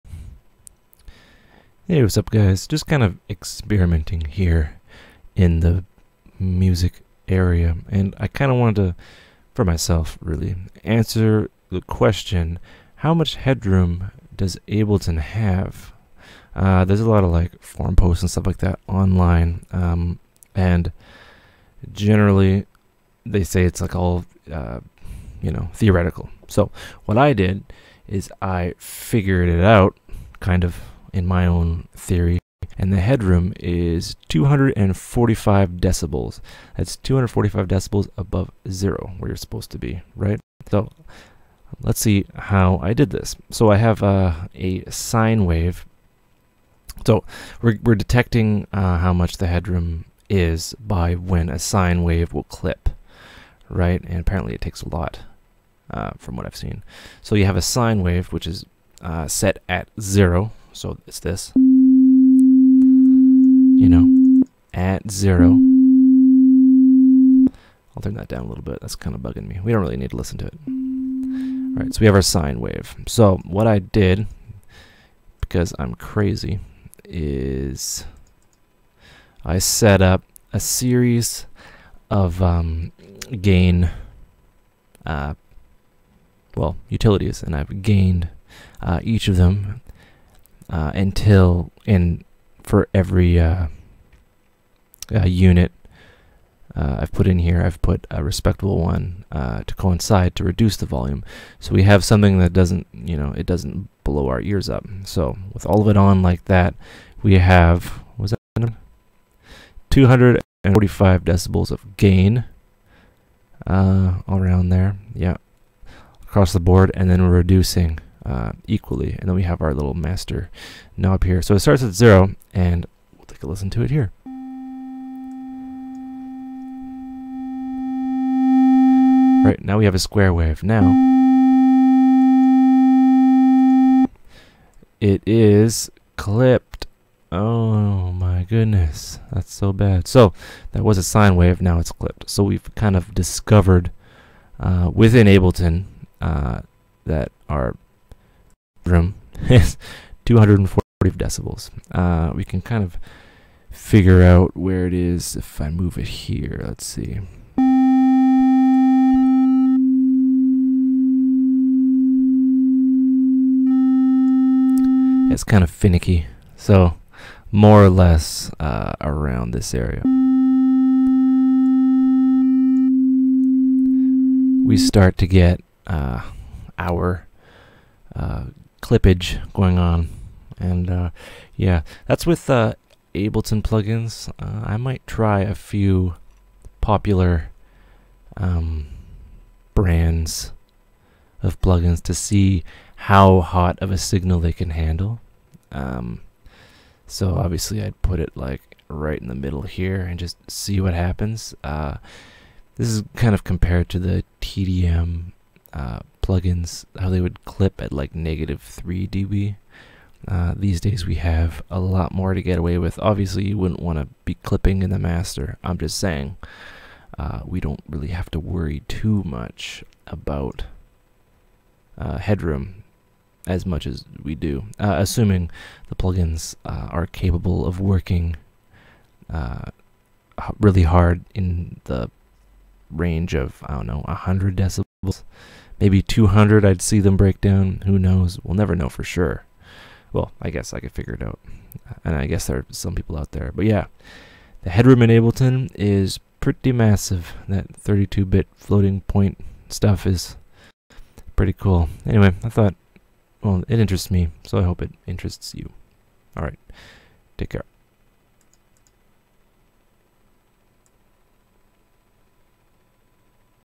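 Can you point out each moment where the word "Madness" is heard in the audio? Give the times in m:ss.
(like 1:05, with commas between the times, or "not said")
not said.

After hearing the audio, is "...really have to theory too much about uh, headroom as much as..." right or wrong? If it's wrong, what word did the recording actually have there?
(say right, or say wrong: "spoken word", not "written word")
wrong: "worry", not "theory".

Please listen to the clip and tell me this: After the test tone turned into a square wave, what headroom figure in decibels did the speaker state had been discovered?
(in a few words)
240 decibels.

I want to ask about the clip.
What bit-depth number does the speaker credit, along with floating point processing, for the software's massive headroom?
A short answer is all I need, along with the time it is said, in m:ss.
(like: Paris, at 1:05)
32, at 4:07.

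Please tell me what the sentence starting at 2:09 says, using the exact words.
Right, now we have a square wave.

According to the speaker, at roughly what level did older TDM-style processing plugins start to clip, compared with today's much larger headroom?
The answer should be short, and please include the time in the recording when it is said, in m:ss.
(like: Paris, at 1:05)
-3 dB, at 3:28.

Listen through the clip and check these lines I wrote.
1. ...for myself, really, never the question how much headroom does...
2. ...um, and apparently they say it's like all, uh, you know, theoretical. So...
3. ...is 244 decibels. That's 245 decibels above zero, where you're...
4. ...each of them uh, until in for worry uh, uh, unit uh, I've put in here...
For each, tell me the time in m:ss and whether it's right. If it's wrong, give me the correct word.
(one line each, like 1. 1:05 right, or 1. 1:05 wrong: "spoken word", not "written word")
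1. 0:09 wrong: "answer", not "never"
2. 0:19 wrong: "generally", not "apparently"
3. 0:33 wrong: "245", not "244"
4. 1:29 wrong: "every", not "worry".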